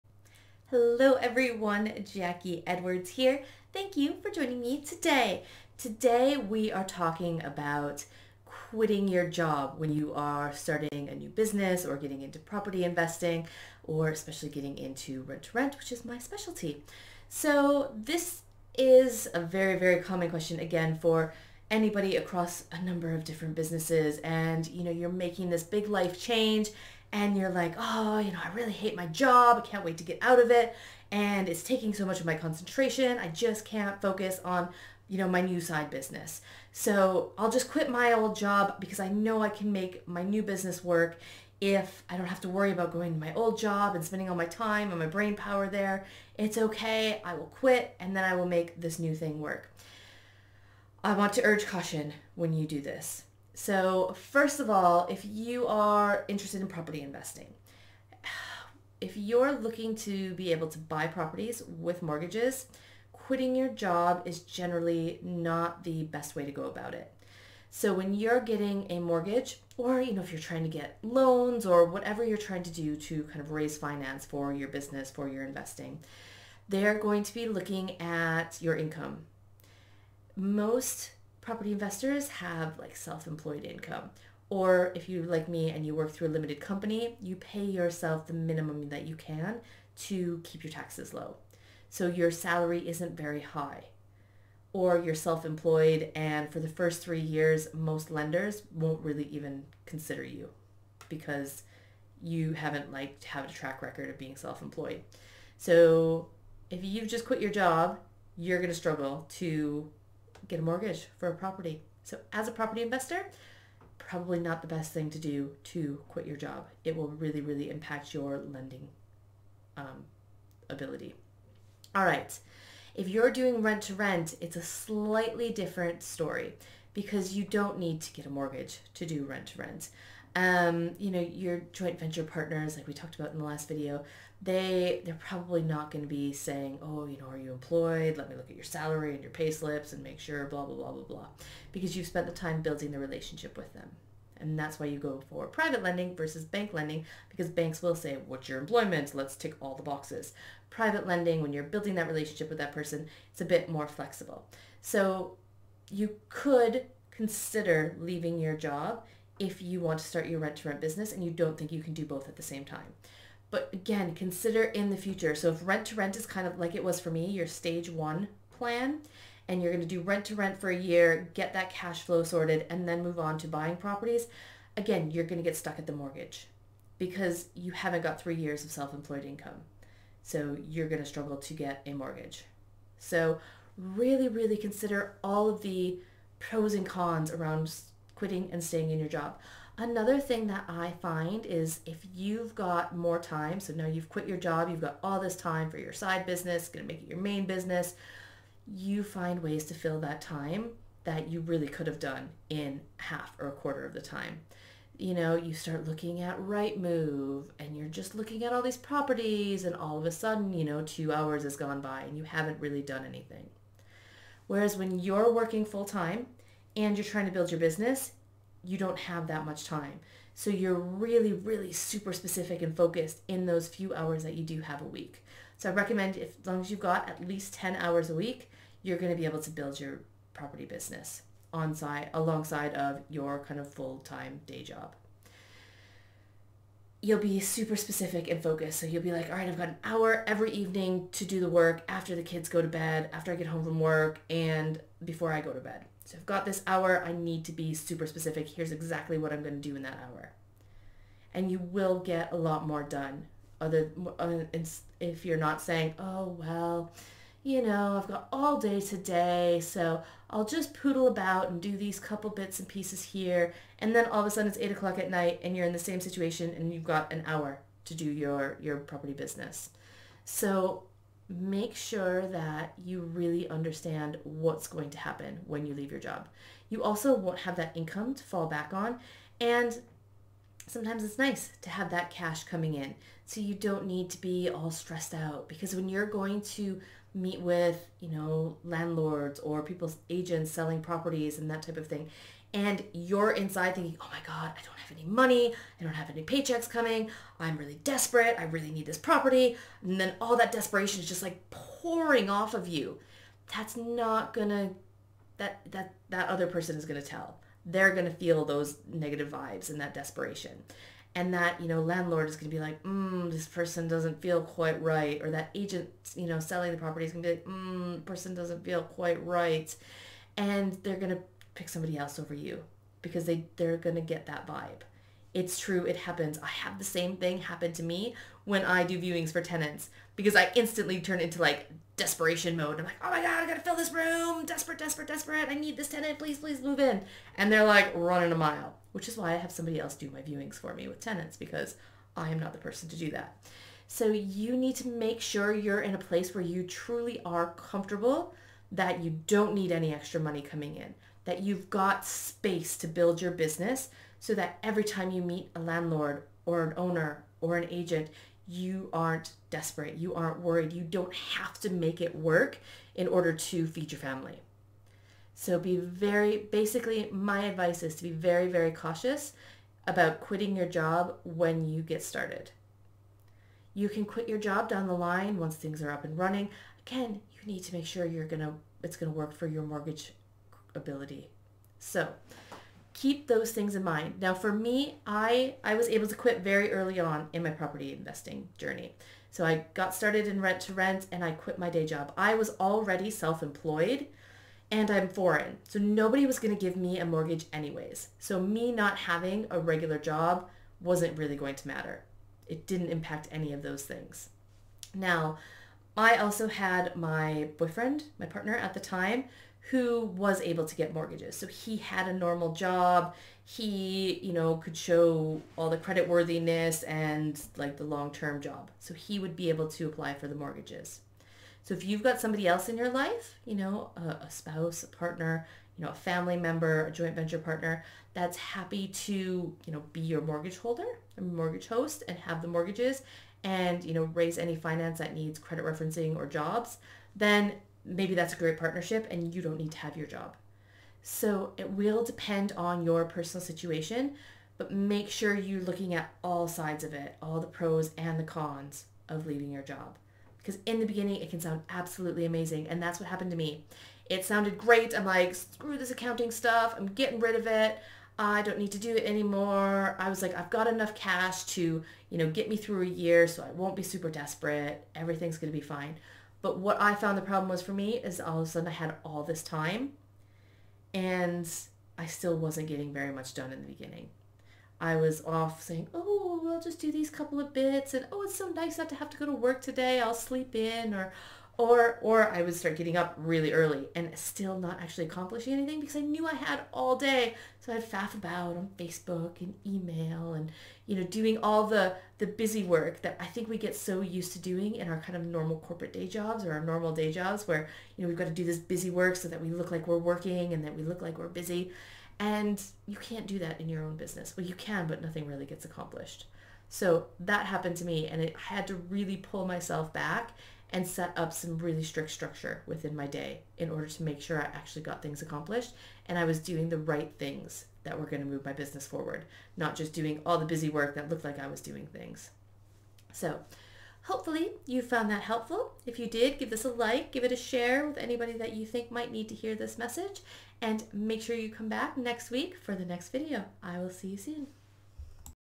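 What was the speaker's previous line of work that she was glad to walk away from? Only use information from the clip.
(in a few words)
Accounting.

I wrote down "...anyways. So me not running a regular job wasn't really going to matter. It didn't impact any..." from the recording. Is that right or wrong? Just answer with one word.
wrong.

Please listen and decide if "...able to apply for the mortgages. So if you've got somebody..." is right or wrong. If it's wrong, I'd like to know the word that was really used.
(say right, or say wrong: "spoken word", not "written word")
right.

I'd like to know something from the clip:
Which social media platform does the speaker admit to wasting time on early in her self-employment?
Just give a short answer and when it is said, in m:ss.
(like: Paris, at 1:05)
Facebook, at 8:08.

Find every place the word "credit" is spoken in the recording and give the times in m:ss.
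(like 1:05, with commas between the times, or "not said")
6:55, 7:15.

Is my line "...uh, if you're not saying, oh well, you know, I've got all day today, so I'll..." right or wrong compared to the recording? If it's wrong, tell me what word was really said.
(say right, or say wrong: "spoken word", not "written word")
right.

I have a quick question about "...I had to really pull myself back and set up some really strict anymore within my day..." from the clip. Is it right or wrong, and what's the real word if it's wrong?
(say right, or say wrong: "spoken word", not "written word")
wrong: "structure", not "anymore".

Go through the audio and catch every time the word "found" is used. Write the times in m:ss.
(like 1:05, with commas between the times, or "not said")
7:46, 8:44.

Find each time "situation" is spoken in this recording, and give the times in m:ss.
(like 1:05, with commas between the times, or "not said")
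4:26, 7:23.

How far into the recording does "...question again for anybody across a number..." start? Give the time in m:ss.
0:20.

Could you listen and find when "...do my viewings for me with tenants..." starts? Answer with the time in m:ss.
5:39.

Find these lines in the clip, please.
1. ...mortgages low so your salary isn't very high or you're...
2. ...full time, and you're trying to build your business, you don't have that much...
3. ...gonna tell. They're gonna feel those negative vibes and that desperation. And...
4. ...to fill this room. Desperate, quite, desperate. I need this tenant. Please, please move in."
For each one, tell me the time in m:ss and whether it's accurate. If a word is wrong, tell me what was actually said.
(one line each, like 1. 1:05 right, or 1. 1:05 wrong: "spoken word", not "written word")
1. 1:30 wrong: "taxes", not "mortgages"
2. 3:35 right
3. 5:06 right
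4. 5:33 wrong: "desperate", not "quite".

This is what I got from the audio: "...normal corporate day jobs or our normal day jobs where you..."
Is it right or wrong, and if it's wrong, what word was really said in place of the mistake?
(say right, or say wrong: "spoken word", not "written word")
right.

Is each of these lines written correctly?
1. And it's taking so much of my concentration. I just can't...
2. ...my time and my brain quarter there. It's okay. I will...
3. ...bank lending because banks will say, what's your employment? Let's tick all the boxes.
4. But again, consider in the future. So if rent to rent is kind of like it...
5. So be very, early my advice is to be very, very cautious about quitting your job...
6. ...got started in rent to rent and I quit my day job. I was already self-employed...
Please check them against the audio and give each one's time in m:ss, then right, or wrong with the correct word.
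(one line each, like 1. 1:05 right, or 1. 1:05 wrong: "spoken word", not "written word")
1. 0:31 right
2. 0:44 wrong: "power", not "quarter"
3. 2:26 right
4. 2:43 right
5. 6:05 wrong: "basically", not "early"
6. 6:29 right.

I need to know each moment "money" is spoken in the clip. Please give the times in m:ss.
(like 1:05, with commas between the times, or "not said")
4:55, 5:50.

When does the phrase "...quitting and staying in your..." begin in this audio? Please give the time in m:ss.
3:08.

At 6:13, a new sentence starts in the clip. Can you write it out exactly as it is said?
You can quit your job down the line once things are up and running.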